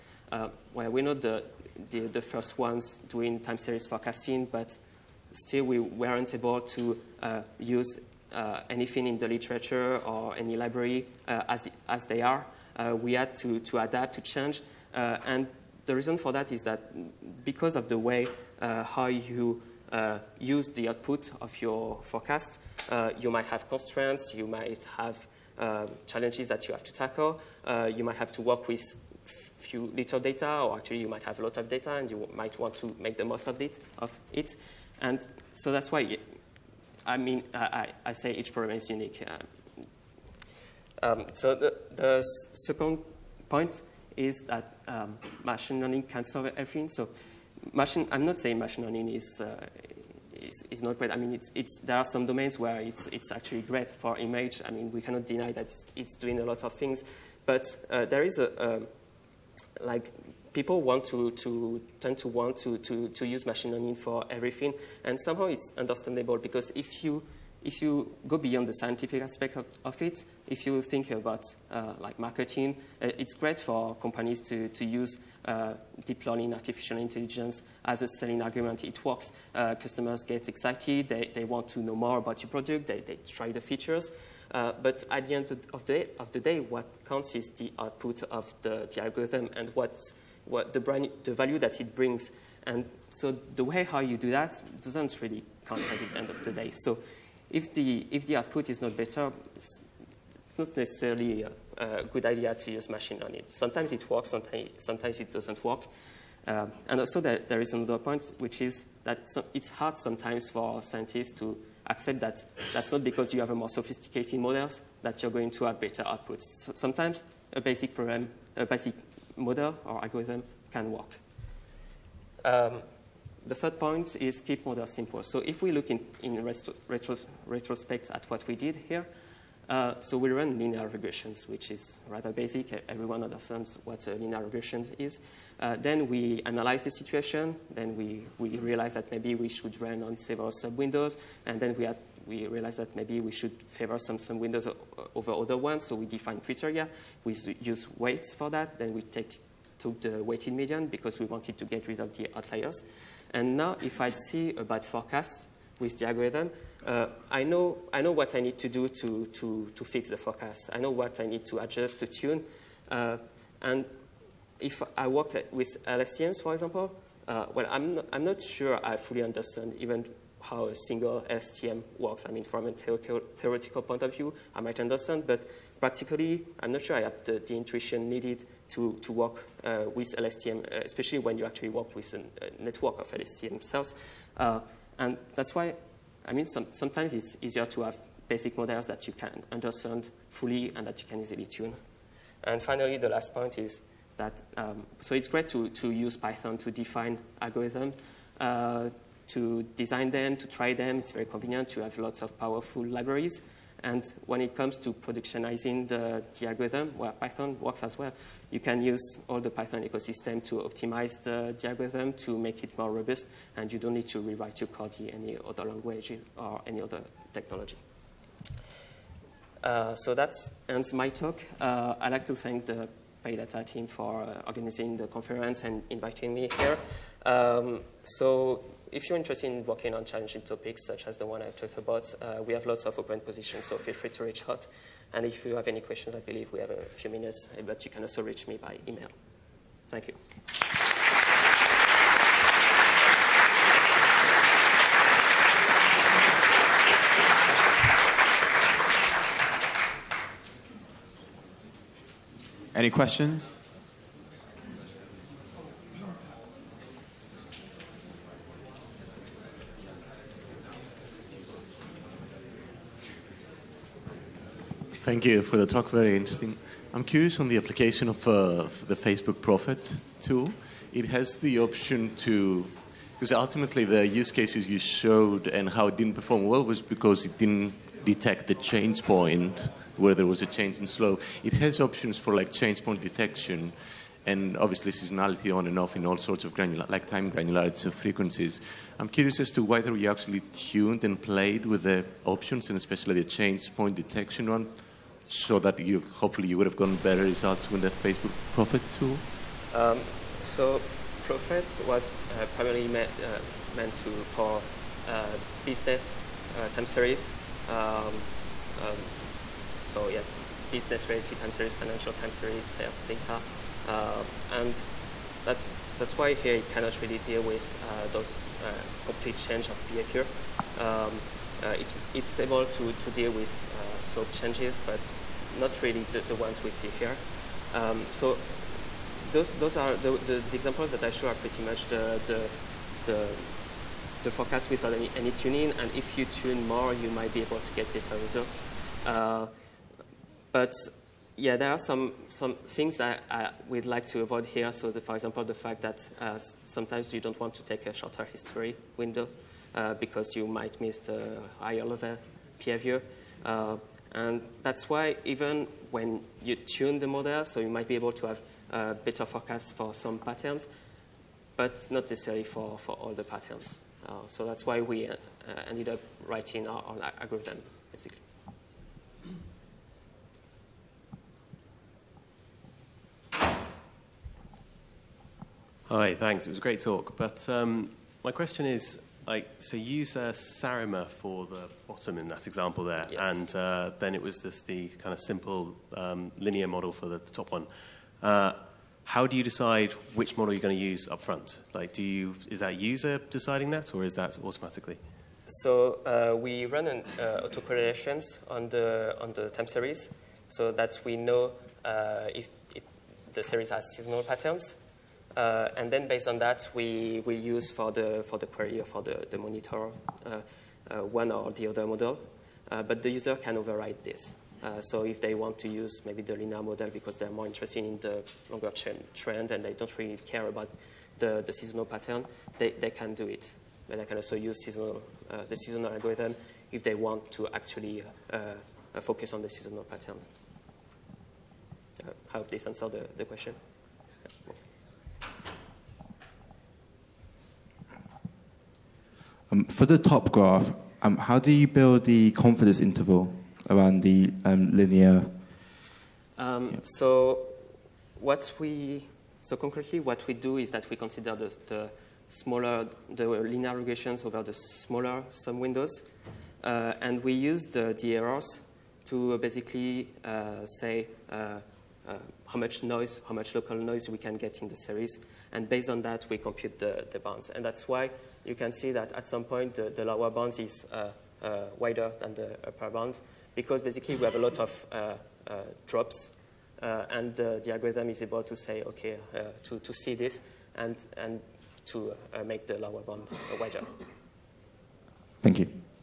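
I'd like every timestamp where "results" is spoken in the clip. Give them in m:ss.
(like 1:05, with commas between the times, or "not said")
4:57, 5:38.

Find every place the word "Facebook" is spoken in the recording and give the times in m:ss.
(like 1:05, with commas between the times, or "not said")
4:28, 4:57.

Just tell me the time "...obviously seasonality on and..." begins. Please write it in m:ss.
4:44.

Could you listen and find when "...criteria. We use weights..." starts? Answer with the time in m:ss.
2:26.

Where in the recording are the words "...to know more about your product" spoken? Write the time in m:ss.
1:21.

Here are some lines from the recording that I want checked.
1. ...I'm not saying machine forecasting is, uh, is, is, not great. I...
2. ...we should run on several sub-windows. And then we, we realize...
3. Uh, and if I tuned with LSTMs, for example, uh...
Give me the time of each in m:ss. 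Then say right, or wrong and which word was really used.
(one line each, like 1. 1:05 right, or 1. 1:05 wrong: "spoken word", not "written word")
1. 0:48 wrong: "learning", not "forecasting"
2. 2:19 right
3. 2:42 wrong: "worked", not "tuned".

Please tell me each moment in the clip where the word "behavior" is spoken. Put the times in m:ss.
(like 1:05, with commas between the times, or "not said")
5:19, 5:52.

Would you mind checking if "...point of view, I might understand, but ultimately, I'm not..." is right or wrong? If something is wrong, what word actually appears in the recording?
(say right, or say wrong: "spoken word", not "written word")
wrong: "practically", not "ultimately".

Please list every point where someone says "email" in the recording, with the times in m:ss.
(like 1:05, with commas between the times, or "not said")
3:58.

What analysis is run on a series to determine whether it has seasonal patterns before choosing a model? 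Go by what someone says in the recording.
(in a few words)
autocorrelations.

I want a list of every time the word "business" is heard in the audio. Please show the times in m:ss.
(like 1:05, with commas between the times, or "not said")
5:05, 5:10.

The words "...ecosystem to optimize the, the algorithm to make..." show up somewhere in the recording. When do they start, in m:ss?
3:29.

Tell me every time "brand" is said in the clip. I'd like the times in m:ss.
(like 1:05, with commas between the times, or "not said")
1:30.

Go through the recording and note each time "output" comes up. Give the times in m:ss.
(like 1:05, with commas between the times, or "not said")
0:20, 1:27, 1:38, 1:56.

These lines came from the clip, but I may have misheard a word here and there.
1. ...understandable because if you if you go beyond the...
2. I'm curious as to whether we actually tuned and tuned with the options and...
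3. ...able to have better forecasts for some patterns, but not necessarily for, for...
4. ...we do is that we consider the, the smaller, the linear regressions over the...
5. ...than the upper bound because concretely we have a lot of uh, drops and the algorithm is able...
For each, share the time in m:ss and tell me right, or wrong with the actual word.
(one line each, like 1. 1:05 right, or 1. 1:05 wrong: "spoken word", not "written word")
1. 1:05 right
2. 4:48 wrong: "played", not "tuned"
3. 5:57 right
4. 7:30 right
5. 7:52 wrong: "basically", not "concretely".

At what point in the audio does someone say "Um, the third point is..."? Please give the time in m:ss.
2:02.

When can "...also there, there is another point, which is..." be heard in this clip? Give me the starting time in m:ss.
1:46.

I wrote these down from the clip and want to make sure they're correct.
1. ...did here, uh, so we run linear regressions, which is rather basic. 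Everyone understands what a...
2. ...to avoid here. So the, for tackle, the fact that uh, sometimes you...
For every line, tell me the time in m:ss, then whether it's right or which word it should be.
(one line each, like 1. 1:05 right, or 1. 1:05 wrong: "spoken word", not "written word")
1. 2:08 right
2. 5:44 wrong: "example", not "tackle".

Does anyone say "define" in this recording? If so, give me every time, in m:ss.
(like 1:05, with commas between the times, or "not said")
2:26, 3:16.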